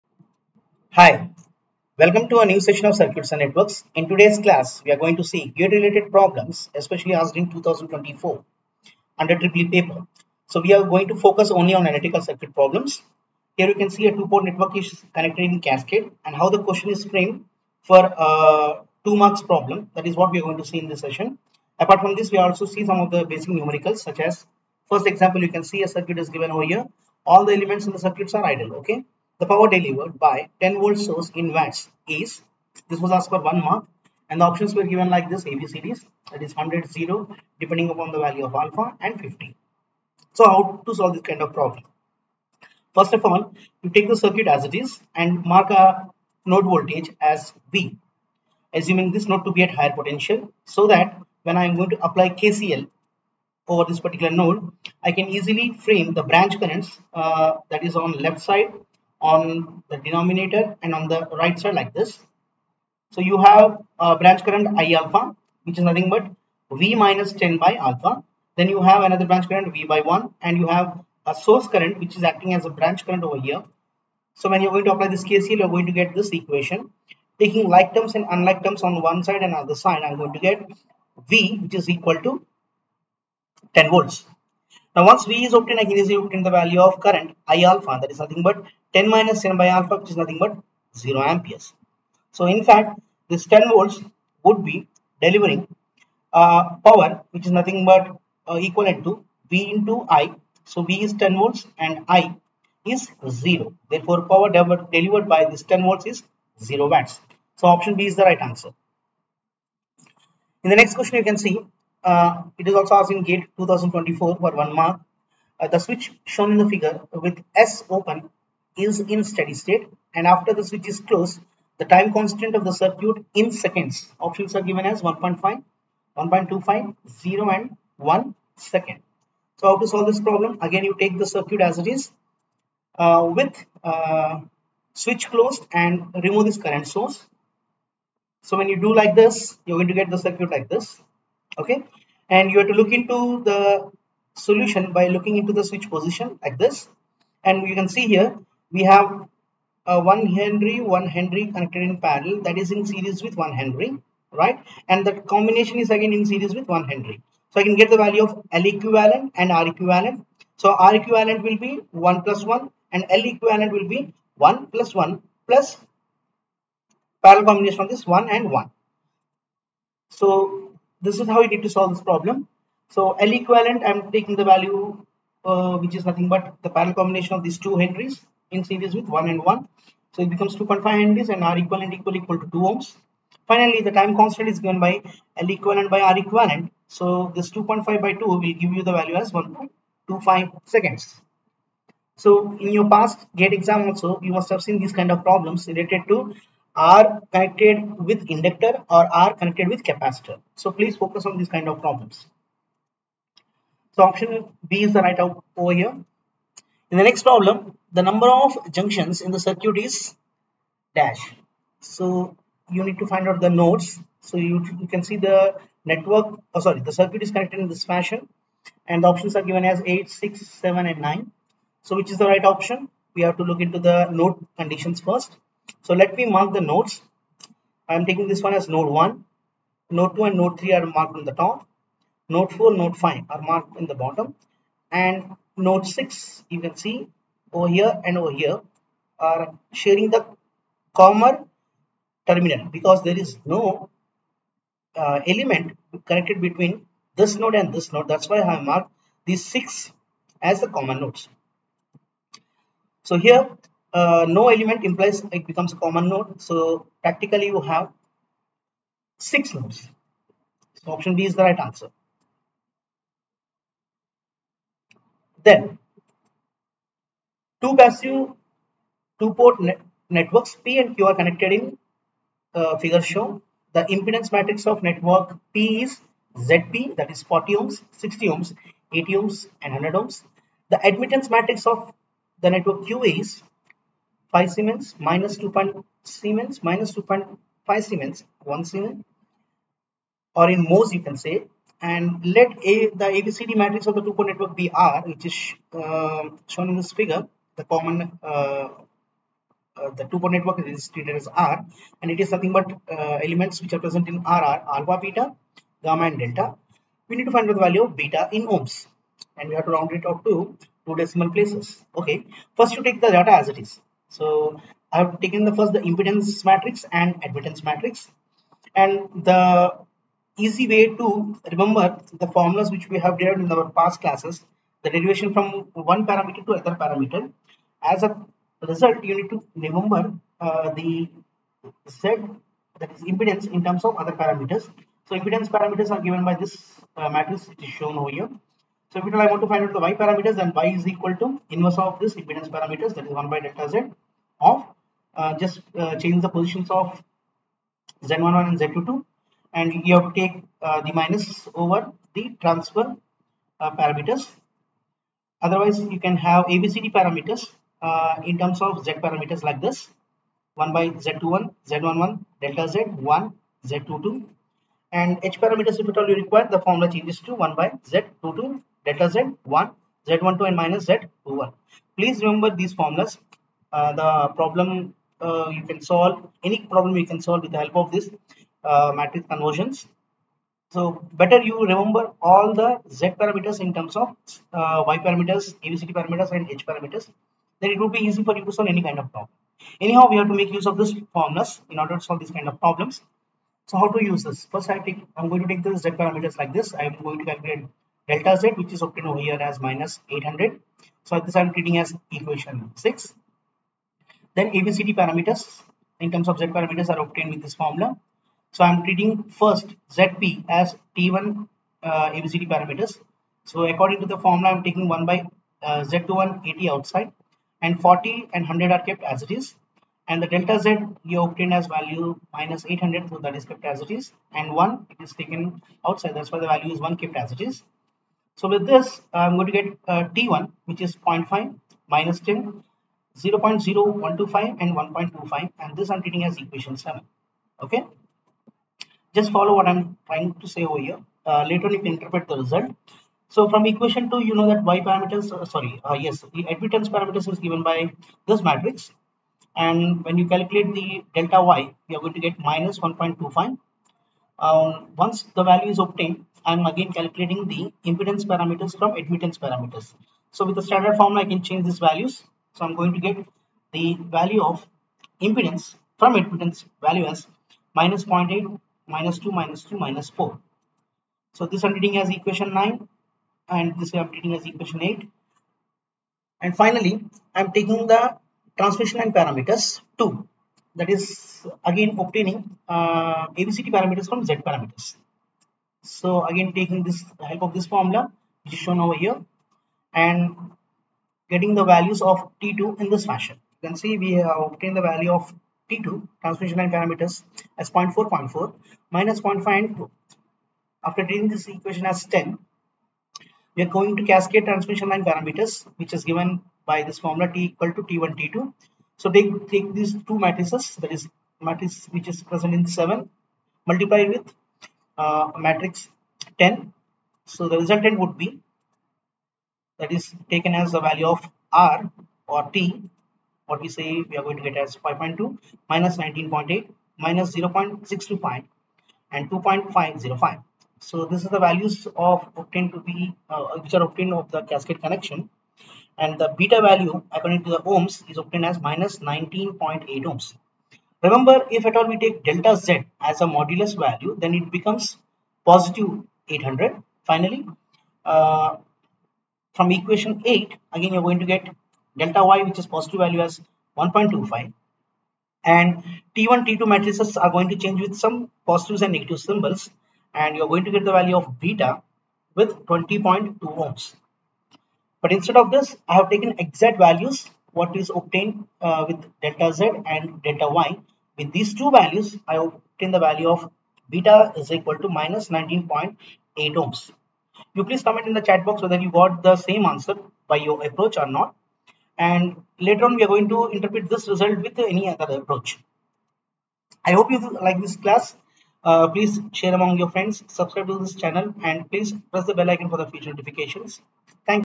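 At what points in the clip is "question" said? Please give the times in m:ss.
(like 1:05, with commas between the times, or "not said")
0:16, 1:50.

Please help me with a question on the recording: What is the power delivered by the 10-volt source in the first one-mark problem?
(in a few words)
0 watts.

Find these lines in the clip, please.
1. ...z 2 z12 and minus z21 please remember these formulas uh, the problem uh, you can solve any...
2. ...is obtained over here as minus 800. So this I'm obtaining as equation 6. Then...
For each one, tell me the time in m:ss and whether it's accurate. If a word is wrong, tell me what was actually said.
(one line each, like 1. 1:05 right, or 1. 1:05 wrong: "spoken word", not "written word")
1. 6:09 wrong: "1", not "2"
2. 6:38 wrong: "treating", not "obtaining".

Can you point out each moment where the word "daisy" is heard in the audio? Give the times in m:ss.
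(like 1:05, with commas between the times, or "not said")
not said.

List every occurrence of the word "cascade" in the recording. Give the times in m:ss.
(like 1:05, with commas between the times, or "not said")
0:15, 8:24, 8:54.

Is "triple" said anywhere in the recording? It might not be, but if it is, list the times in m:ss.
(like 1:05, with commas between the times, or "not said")
0:09.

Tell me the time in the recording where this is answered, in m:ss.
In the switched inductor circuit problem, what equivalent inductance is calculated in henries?
3:00.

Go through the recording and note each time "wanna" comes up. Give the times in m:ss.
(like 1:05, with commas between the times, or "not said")
not said.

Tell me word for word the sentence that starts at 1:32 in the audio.
So in fact this 10 volts would be delivering uh, power which is nothing but uh, equivalent to V into I.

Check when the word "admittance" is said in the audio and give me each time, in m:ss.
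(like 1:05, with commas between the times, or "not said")
4:40, 5:17, 7:26, 7:38, 7:46.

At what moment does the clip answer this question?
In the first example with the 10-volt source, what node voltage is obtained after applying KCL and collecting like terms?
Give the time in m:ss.
1:21.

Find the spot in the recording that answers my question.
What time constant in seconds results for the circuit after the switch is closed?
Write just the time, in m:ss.
3:09.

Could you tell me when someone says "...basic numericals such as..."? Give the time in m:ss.
0:23.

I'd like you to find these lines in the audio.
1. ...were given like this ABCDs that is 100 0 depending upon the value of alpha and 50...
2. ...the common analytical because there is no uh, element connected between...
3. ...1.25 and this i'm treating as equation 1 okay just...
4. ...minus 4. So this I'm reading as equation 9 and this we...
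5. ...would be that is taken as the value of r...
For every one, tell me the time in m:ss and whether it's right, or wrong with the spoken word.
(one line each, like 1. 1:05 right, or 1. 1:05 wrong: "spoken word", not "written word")
1. 0:34 right
2. 4:00 wrong: "terminal", not "analytical"
3. 7:14 wrong: "7", not "1"
4. 7:49 right
5. 8:38 right.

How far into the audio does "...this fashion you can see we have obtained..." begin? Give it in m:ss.
8:12.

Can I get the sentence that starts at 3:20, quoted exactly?
So please focus on these kind of problems.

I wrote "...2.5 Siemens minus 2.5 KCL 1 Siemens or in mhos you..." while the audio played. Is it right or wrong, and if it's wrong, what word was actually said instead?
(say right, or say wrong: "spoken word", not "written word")
wrong: "Siemens", not "KCL".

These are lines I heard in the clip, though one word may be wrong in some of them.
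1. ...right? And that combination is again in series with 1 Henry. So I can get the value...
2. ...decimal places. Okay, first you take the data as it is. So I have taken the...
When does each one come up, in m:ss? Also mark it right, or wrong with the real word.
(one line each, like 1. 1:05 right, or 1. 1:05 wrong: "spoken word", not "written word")
1. 2:34 right
2. 5:10 right.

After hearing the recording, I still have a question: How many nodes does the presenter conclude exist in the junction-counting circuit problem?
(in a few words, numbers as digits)
6.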